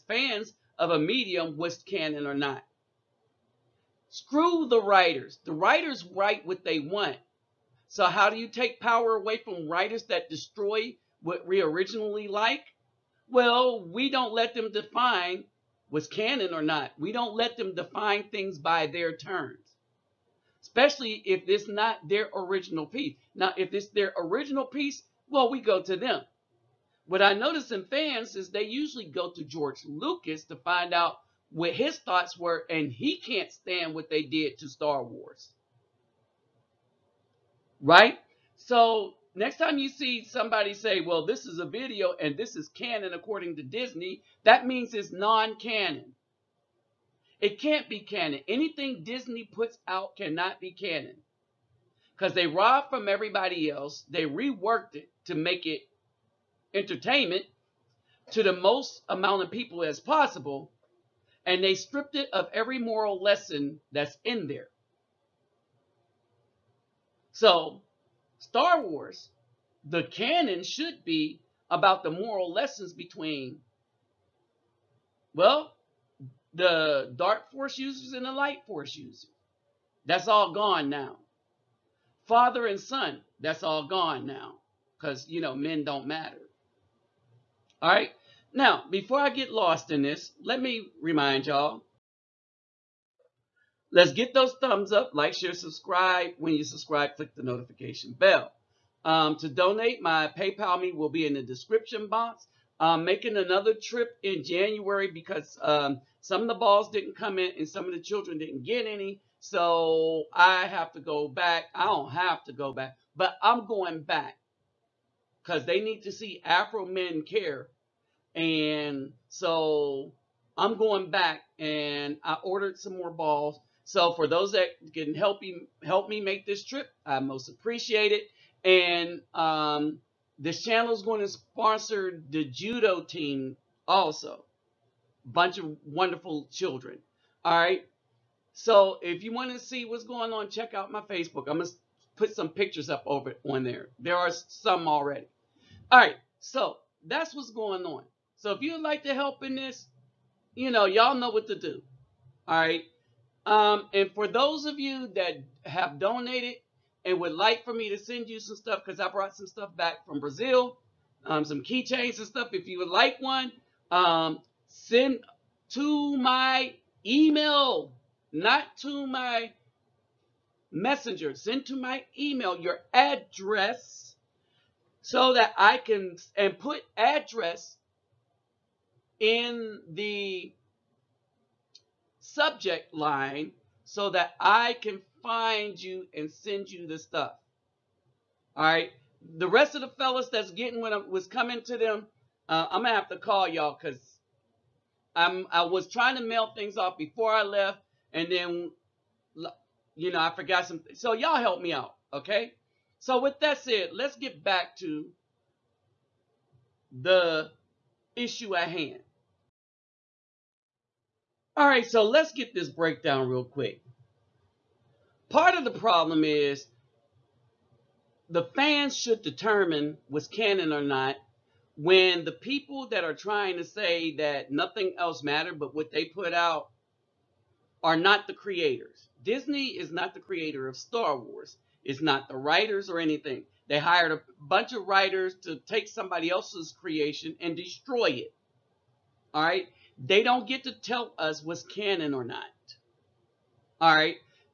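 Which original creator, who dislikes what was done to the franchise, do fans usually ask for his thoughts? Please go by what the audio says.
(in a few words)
George Lucas.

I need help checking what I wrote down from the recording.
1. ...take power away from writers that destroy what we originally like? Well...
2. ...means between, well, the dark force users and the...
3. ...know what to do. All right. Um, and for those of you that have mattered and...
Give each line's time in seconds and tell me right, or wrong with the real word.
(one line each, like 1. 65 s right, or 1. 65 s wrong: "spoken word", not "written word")
1. 8 s right
2. 72 s wrong: "lessons", not "means"
3. 151 s wrong: "donated", not "mattered".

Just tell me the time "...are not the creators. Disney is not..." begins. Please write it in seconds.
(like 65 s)
227 s.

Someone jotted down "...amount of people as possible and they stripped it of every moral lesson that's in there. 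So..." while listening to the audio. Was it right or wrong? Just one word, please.
right.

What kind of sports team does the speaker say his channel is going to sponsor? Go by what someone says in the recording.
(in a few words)
Judo team.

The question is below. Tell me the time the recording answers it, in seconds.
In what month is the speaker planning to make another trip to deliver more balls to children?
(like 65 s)
104 s.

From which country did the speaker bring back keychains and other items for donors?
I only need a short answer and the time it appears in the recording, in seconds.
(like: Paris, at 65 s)
Brazil, at 160 s.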